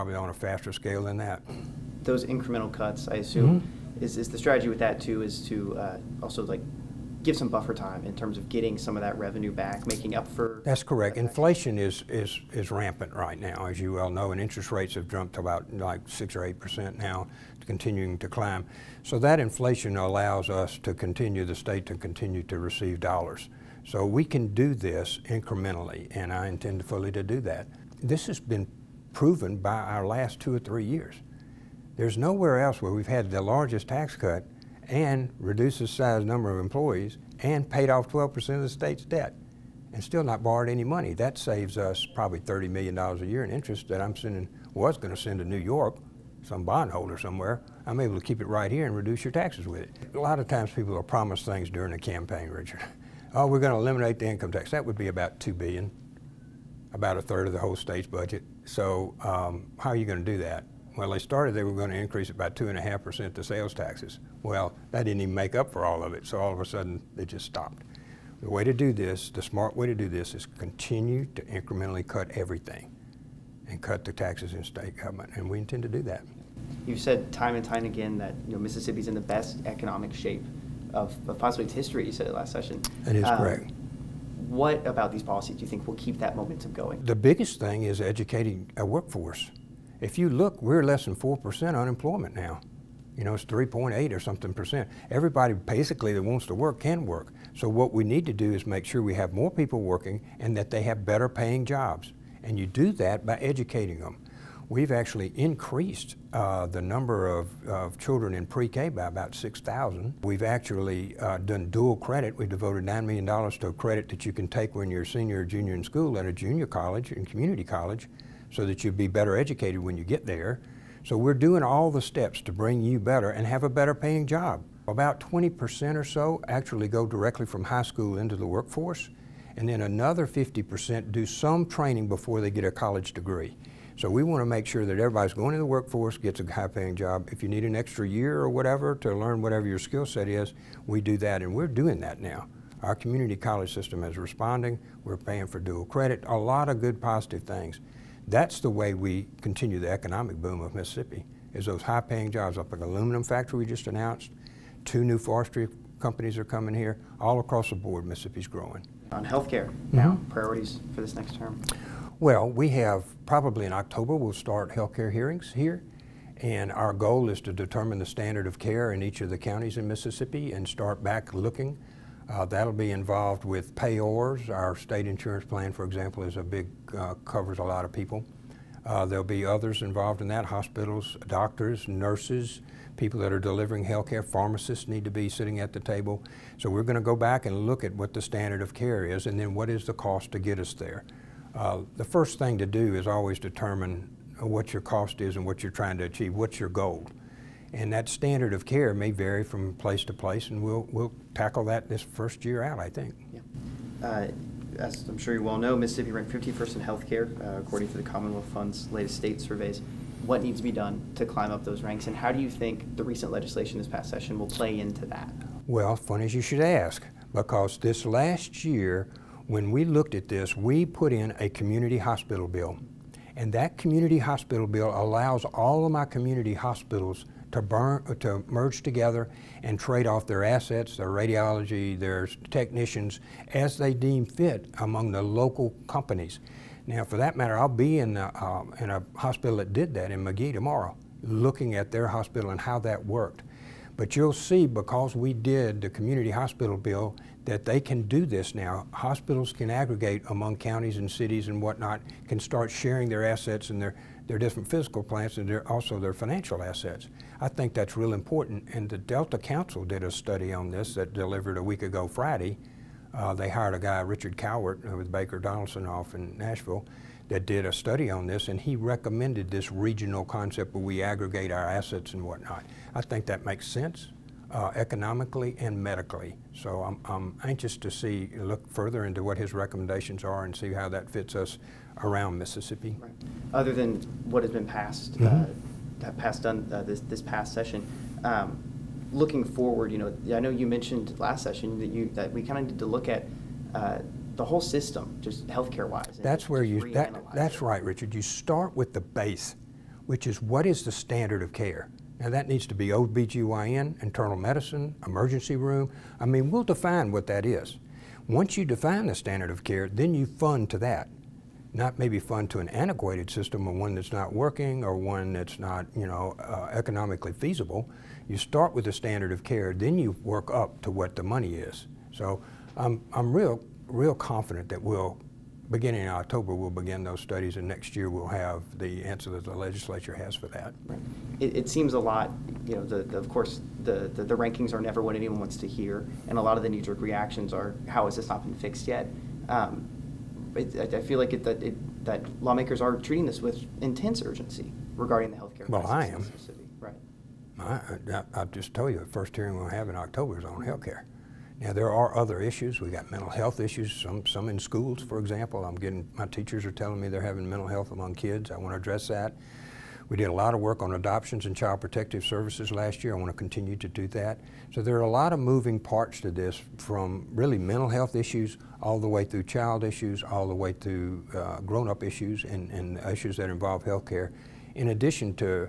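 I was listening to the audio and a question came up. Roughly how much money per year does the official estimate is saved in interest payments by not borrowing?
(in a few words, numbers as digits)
$30 million.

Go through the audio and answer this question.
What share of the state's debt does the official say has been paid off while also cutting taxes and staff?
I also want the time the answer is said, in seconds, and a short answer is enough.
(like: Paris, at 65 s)
12%, at 38 s.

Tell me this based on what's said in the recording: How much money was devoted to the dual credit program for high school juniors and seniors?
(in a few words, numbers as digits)
$9 million.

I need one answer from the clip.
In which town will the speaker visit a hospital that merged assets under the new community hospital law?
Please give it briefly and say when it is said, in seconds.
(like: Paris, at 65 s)
Magee, at 240 s.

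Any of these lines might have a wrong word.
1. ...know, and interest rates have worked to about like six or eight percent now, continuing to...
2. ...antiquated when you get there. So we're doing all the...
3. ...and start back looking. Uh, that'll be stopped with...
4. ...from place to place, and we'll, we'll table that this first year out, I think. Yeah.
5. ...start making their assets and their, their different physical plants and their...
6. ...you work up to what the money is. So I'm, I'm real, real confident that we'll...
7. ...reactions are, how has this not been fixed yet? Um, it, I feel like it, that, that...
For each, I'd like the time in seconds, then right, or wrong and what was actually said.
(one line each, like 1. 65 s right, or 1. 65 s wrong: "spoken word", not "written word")
1. 14 s wrong: "jumped", not "worked"
2. 119 s wrong: "educated", not "antiquated"
3. 170 s wrong: "involved", not "stopped"
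4. 199 s wrong: "tackle", not "table"
5. 252 s wrong: "sharing", not "making"
6. 319 s right
7. 337 s right.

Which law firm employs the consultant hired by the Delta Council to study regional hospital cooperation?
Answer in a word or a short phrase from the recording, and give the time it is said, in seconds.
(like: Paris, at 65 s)
Baker Donelson, at 265 s.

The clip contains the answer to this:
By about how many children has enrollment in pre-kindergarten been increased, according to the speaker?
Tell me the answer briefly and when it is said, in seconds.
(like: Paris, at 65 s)
6,000, at 109 s.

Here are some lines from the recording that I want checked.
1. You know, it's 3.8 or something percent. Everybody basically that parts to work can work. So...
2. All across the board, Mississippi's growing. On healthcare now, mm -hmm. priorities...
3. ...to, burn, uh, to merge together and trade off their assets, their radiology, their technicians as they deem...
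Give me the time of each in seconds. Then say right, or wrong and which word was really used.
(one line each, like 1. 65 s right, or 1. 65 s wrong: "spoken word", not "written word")
1. 93 s wrong: "wants", not "parts"
2. 157 s right
3. 227 s right.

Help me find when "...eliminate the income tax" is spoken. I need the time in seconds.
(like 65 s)
53 s.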